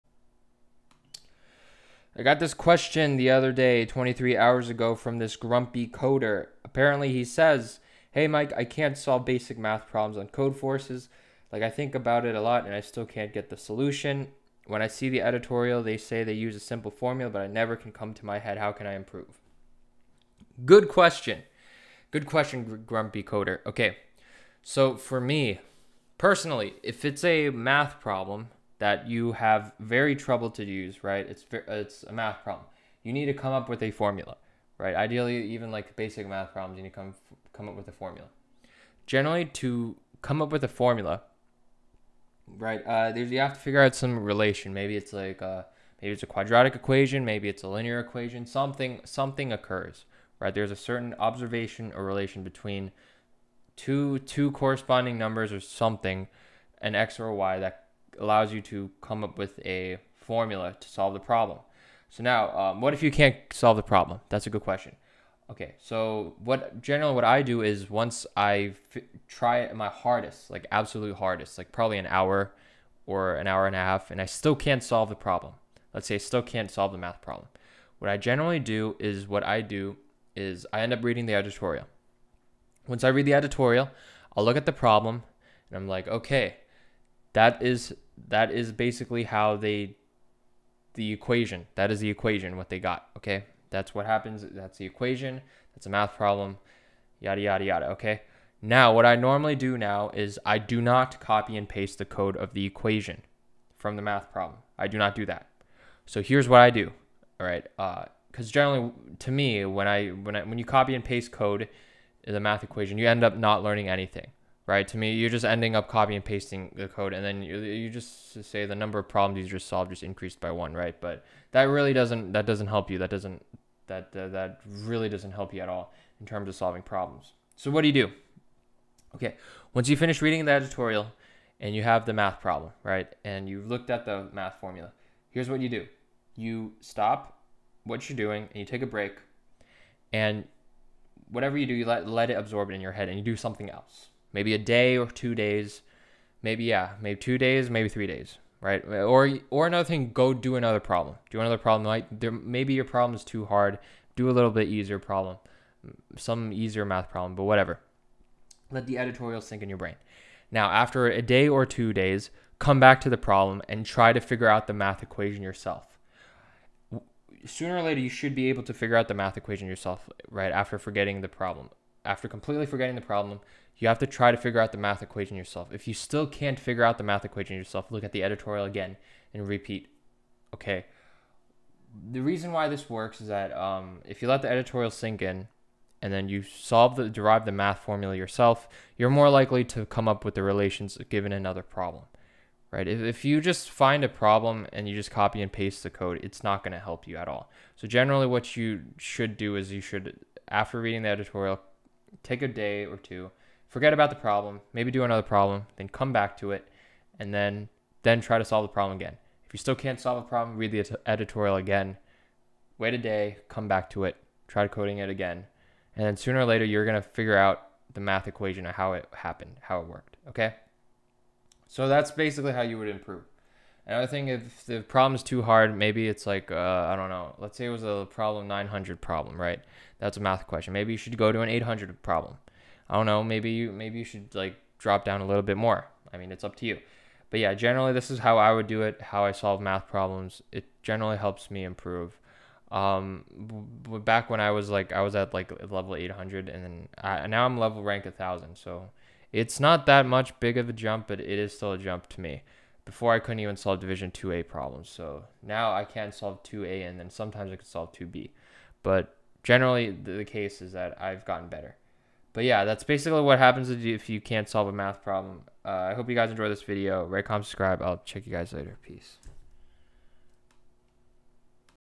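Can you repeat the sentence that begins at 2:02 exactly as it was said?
That doesn't that uh, that really doesn't help you at all in terms of solving problems.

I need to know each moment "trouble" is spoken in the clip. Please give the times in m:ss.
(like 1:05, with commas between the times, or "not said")
0:30.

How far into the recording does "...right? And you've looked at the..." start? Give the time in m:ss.
2:12.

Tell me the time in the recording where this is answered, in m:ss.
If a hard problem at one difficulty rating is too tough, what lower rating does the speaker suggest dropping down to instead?
3:51.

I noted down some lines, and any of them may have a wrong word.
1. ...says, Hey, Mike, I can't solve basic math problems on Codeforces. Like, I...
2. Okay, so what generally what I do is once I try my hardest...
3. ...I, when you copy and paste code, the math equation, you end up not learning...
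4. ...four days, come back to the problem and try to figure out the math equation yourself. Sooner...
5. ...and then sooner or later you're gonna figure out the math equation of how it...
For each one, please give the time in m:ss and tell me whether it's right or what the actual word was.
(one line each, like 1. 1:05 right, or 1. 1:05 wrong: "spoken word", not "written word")
1. 0:07 right
2. 1:05 right
3. 1:50 right
4. 2:41 wrong: "two", not "four"
5. 3:35 right.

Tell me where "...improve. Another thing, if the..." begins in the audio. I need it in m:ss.
3:42.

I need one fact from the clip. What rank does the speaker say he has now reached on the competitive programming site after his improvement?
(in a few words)
1000.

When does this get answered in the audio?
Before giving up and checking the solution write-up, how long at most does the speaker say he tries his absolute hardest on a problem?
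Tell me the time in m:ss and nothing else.
1:13.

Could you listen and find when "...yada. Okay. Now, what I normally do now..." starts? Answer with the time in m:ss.
1:37.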